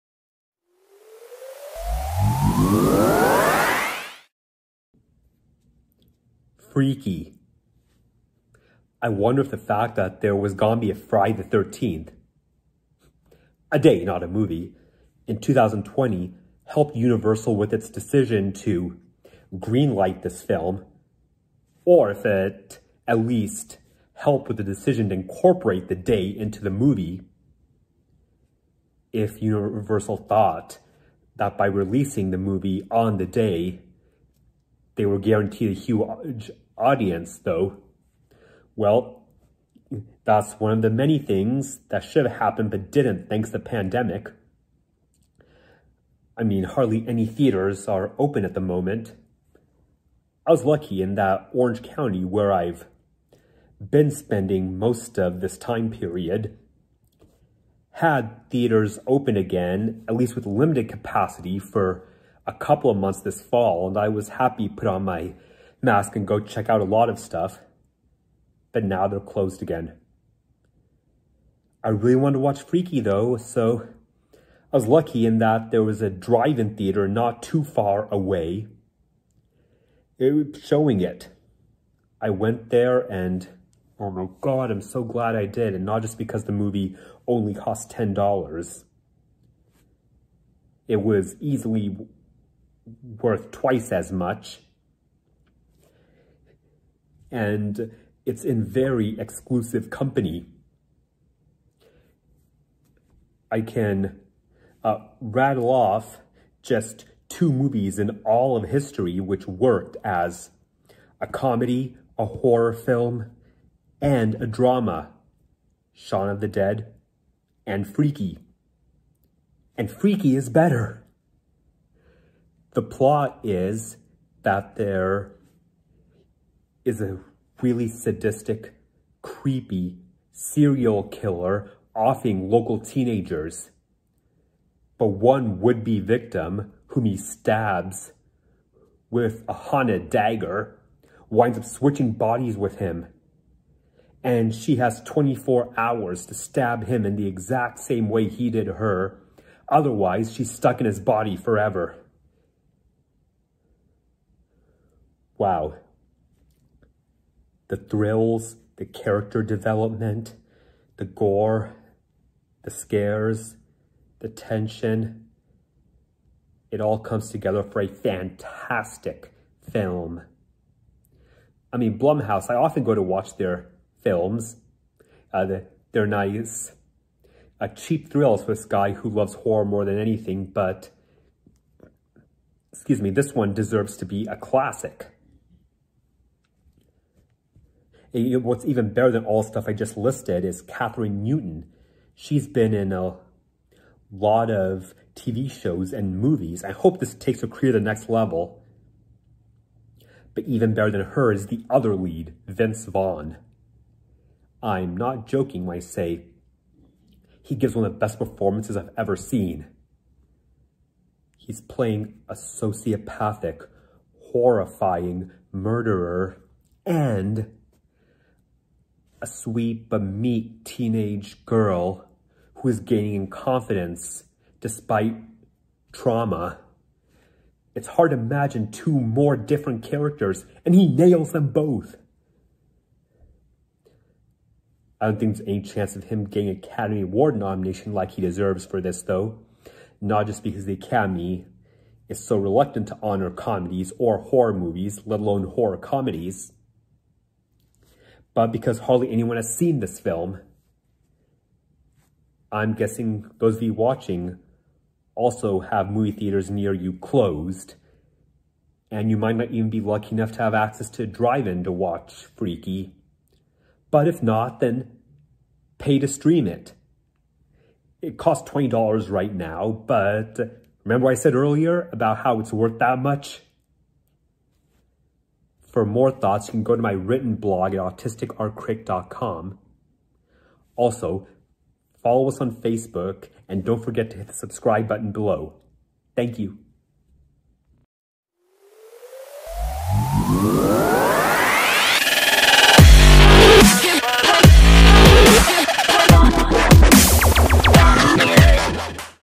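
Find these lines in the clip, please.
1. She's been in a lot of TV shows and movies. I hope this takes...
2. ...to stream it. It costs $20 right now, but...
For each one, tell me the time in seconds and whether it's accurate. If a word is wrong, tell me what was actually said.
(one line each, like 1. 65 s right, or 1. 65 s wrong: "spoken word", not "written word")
1. 192 s right
2. 265 s right.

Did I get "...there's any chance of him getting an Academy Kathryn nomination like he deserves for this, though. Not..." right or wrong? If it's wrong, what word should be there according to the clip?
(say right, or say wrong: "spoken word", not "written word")
wrong: "Award", not "Kathryn".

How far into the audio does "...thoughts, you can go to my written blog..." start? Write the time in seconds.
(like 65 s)
276 s.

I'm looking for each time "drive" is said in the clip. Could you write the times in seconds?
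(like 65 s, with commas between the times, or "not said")
76 s, 261 s.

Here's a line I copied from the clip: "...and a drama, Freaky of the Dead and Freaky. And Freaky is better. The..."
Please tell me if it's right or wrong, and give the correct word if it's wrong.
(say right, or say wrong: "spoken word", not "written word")
wrong: "Shaun", not "Freaky".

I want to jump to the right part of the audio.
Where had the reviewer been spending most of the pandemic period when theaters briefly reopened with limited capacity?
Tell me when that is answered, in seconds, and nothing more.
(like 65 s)
51 s.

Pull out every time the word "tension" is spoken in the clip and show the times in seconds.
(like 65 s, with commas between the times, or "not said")
164 s.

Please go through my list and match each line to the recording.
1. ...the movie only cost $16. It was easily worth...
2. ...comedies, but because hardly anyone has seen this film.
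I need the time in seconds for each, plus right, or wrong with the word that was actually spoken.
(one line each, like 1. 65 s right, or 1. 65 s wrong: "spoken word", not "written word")
1. 86 s wrong: "10", not "16"
2. 245 s right.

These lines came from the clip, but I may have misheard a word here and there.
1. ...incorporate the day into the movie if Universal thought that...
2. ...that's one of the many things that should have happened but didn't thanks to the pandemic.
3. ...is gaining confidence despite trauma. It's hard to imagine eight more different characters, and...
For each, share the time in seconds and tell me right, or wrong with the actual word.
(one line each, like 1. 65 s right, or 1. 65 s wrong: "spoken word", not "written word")
1. 25 s right
2. 40 s right
3. 222 s wrong: "two", not "eight".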